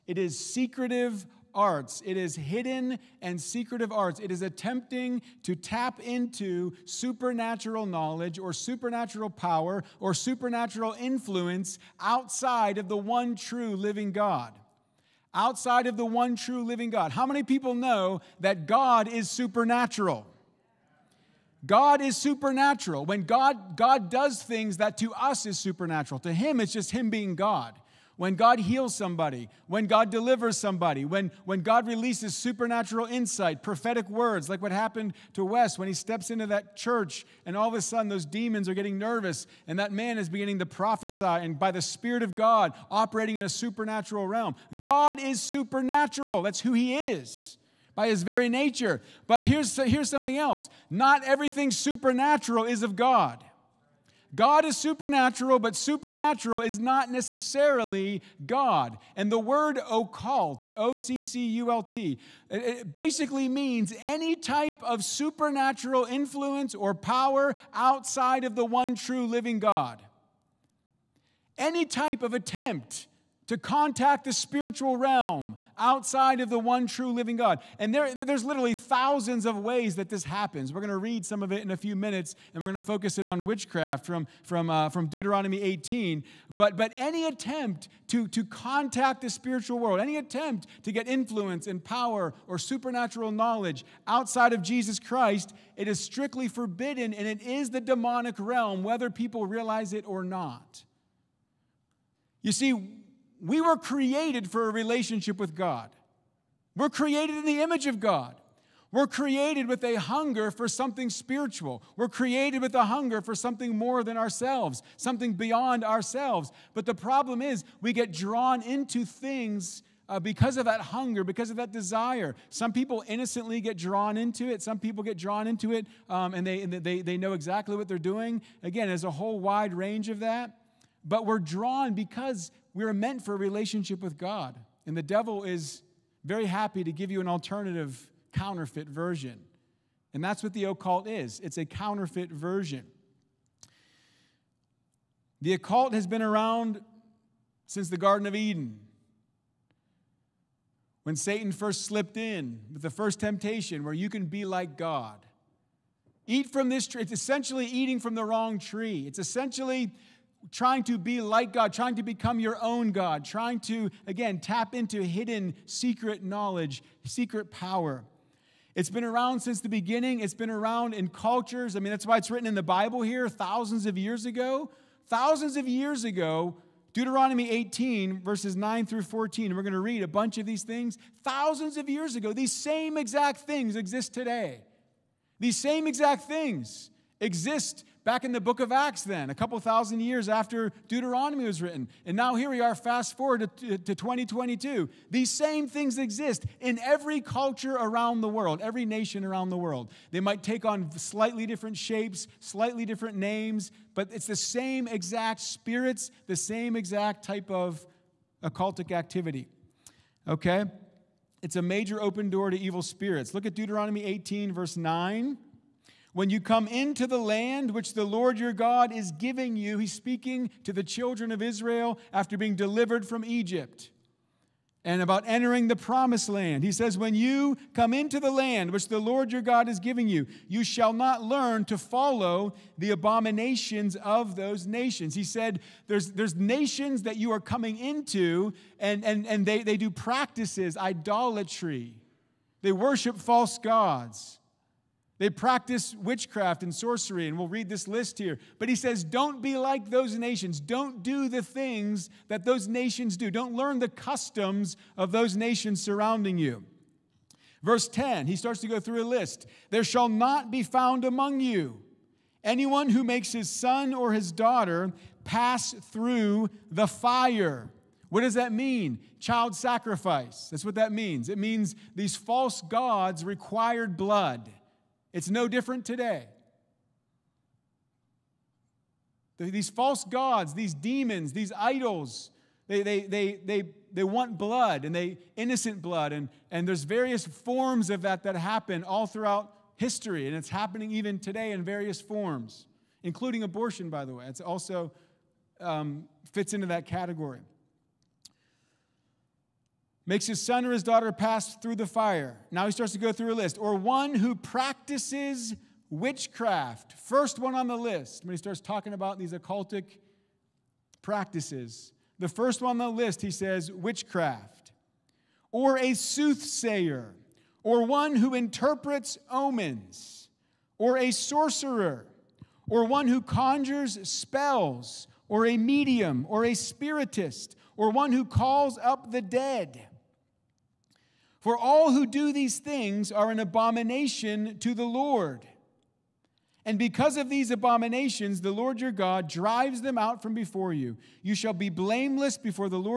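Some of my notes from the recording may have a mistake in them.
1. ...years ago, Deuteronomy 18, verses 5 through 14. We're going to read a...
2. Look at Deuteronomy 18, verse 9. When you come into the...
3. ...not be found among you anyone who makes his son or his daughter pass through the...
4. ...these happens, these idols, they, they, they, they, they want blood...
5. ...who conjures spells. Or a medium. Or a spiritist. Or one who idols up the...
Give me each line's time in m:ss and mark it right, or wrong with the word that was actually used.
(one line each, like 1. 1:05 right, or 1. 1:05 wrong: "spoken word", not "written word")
1. 2:55 wrong: "9", not "5"
2. 3:33 right
3. 4:20 right
4. 4:40 wrong: "demons", not "happens"
5. 5:23 wrong: "calls", not "idols".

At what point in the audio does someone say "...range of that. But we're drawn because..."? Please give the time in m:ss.
2:09.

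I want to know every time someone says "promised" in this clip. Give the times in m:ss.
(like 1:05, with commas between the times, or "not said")
3:45.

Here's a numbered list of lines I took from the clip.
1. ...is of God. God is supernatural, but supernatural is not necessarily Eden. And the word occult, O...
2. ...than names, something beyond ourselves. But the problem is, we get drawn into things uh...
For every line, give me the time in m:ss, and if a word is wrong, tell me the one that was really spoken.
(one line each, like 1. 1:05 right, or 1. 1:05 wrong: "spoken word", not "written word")
1. 0:52 wrong: "God", not "Eden"
2. 1:54 wrong: "ourselves", not "names".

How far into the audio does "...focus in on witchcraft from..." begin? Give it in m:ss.
1:22.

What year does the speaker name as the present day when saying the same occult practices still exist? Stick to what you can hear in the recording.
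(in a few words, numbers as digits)
2022.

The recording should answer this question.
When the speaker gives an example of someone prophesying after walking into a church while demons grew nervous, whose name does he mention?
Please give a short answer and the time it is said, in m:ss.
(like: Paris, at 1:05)
Wes, at 0:35.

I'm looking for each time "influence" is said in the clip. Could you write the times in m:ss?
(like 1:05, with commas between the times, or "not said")
0:10, 1:06, 1:31.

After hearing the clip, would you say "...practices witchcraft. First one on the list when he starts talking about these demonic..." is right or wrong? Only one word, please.
wrong.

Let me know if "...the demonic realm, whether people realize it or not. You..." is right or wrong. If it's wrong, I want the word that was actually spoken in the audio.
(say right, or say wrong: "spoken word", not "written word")
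right.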